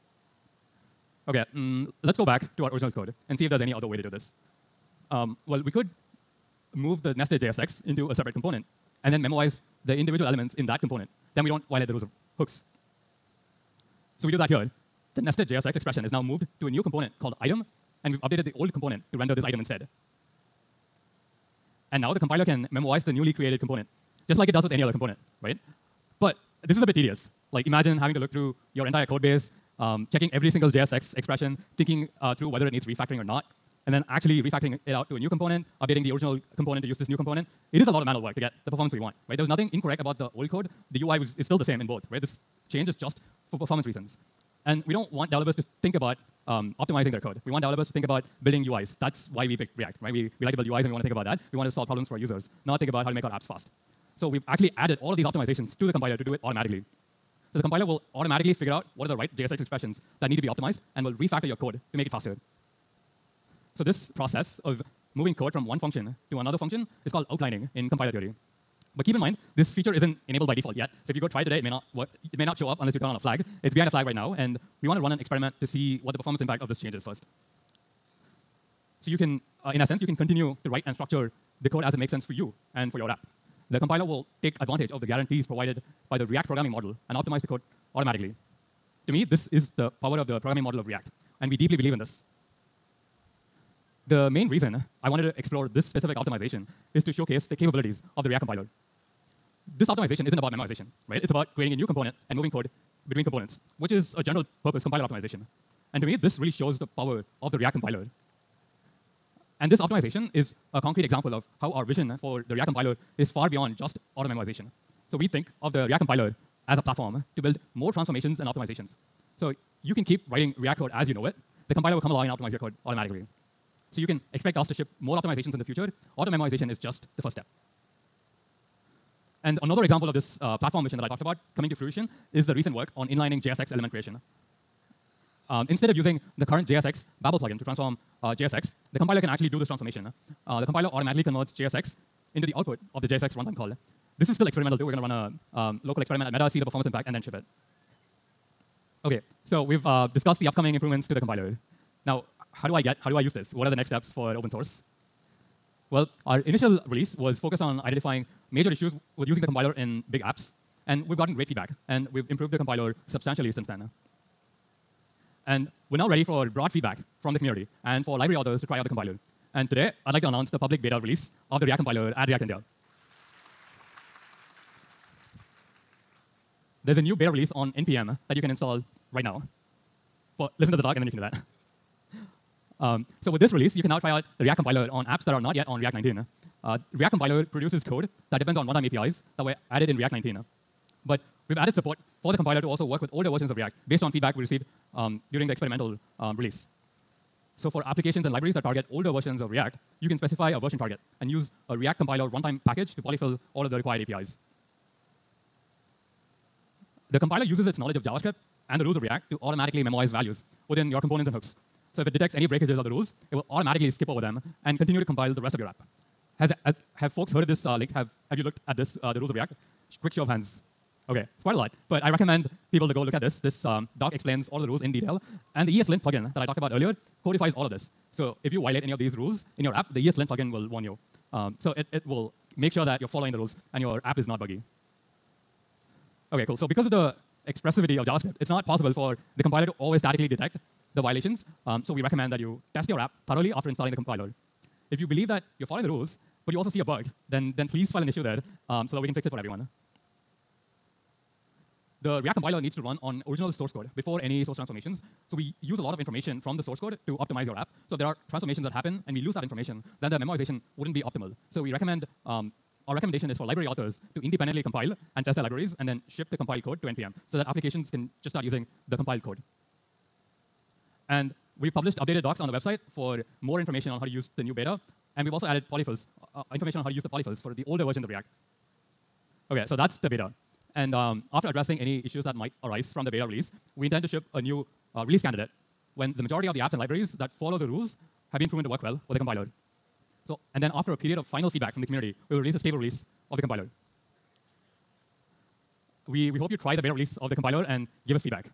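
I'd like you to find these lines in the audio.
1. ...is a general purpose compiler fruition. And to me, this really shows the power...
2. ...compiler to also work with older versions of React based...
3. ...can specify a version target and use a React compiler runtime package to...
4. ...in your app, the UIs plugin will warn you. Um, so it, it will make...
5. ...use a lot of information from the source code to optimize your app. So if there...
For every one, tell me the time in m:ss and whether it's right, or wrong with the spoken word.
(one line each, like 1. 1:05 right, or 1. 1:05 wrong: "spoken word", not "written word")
1. 1:43 wrong: "optimization", not "fruition"
2. 3:12 right
3. 3:20 right
4. 3:49 wrong: "ESLint", not "UIs"
5. 4:15 right.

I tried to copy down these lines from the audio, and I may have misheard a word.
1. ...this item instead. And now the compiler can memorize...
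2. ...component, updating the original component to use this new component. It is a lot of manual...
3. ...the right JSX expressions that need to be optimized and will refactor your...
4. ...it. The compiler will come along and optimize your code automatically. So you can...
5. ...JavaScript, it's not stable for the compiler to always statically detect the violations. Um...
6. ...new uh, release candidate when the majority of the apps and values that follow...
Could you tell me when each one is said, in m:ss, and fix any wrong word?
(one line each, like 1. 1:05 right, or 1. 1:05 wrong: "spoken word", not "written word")
1. 0:19 right
2. 0:35 right
3. 0:59 right
4. 2:01 right
5. 3:58 wrong: "possible", not "stable"
6. 4:44 wrong: "libraries", not "values".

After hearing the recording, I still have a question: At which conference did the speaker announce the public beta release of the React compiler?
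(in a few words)
React India.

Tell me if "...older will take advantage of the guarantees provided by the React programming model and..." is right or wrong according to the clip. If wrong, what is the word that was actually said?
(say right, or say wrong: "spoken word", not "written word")
wrong: "compiler", not "older".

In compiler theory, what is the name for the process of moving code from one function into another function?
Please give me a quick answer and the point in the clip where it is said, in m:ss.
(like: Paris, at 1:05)
Outlining, at 1:07.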